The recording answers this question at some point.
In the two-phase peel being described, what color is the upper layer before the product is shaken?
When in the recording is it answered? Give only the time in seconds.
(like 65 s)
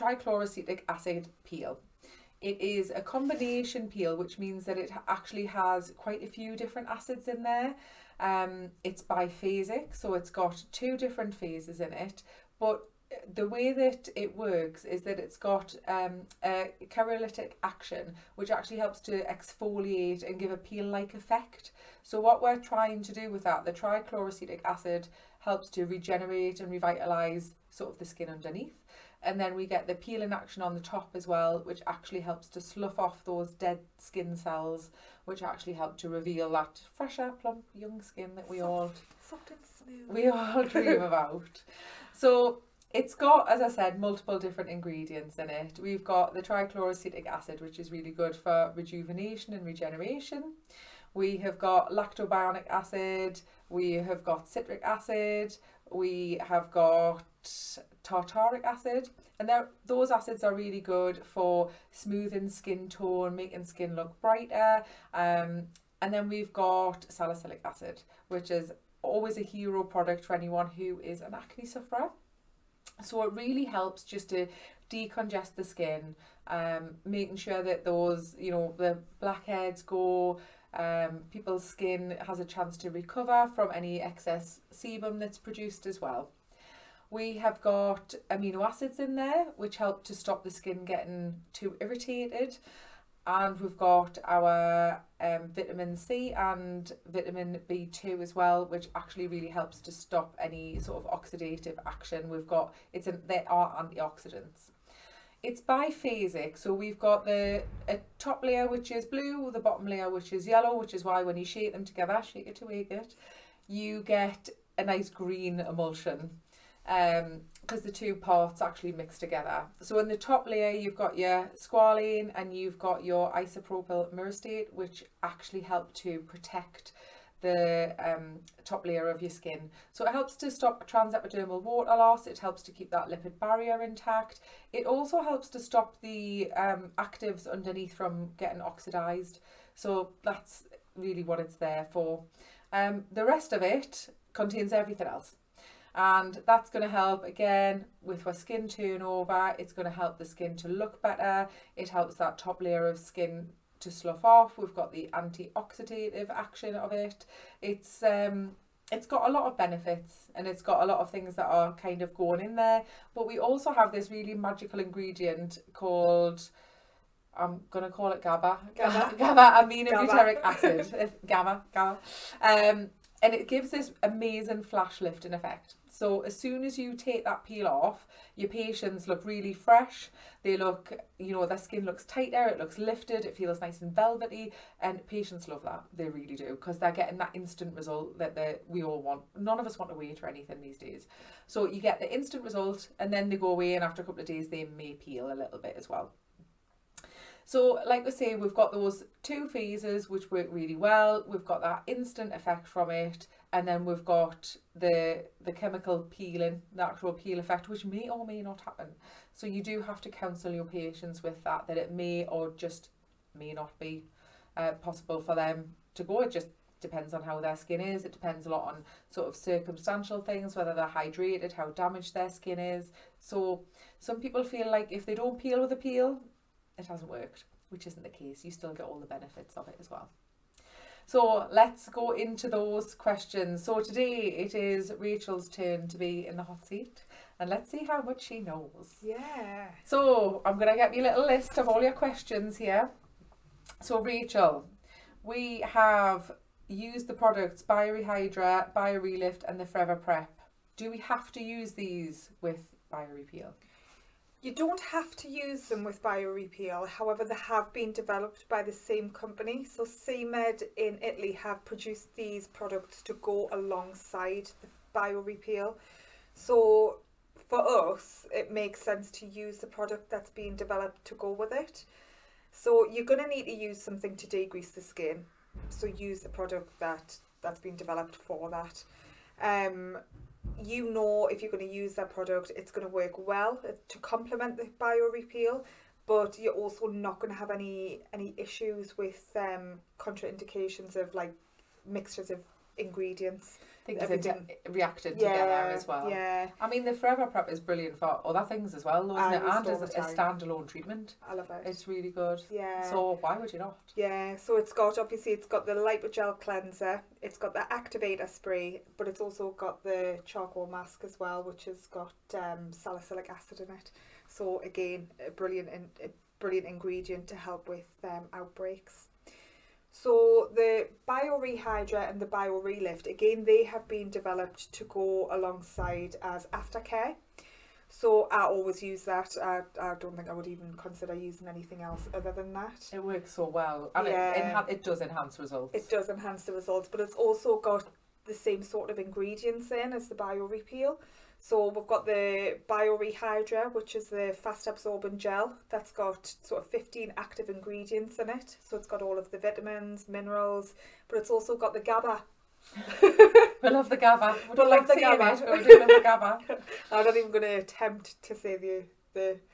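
109 s.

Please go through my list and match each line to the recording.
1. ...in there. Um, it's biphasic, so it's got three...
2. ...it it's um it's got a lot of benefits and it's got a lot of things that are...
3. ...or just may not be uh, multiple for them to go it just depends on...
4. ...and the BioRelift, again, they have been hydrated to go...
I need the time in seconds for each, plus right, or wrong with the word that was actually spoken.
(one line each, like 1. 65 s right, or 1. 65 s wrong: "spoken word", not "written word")
1. 7 s wrong: "two", not "three"
2. 156 s right
3. 212 s wrong: "possible", not "multiple"
4. 322 s wrong: "developed", not "hydrated".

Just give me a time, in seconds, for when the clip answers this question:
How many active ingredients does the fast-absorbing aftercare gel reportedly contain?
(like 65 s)
346 s.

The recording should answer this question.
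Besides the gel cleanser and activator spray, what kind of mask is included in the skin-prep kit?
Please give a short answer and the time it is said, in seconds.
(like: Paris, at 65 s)
Charcoal mask, at 310 s.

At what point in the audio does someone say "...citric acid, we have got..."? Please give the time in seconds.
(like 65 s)
54 s.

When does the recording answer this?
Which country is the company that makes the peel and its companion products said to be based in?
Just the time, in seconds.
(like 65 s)
261 s.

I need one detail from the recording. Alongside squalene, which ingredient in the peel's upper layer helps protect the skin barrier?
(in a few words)
Isopropyl myristate.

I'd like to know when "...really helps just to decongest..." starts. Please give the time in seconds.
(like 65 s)
73 s.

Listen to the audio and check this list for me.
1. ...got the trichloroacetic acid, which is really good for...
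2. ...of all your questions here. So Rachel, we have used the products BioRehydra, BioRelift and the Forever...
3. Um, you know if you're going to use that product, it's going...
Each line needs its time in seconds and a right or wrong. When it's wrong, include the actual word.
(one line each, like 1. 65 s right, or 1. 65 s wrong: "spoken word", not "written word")
1. 46 s right
2. 241 s right
3. 279 s right.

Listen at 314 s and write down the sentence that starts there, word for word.
So again, a brilliant in, a brilliant ingredient to help with um, outbreaks.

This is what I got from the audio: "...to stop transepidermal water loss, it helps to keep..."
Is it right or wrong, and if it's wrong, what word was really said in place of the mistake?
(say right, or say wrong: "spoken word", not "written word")
right.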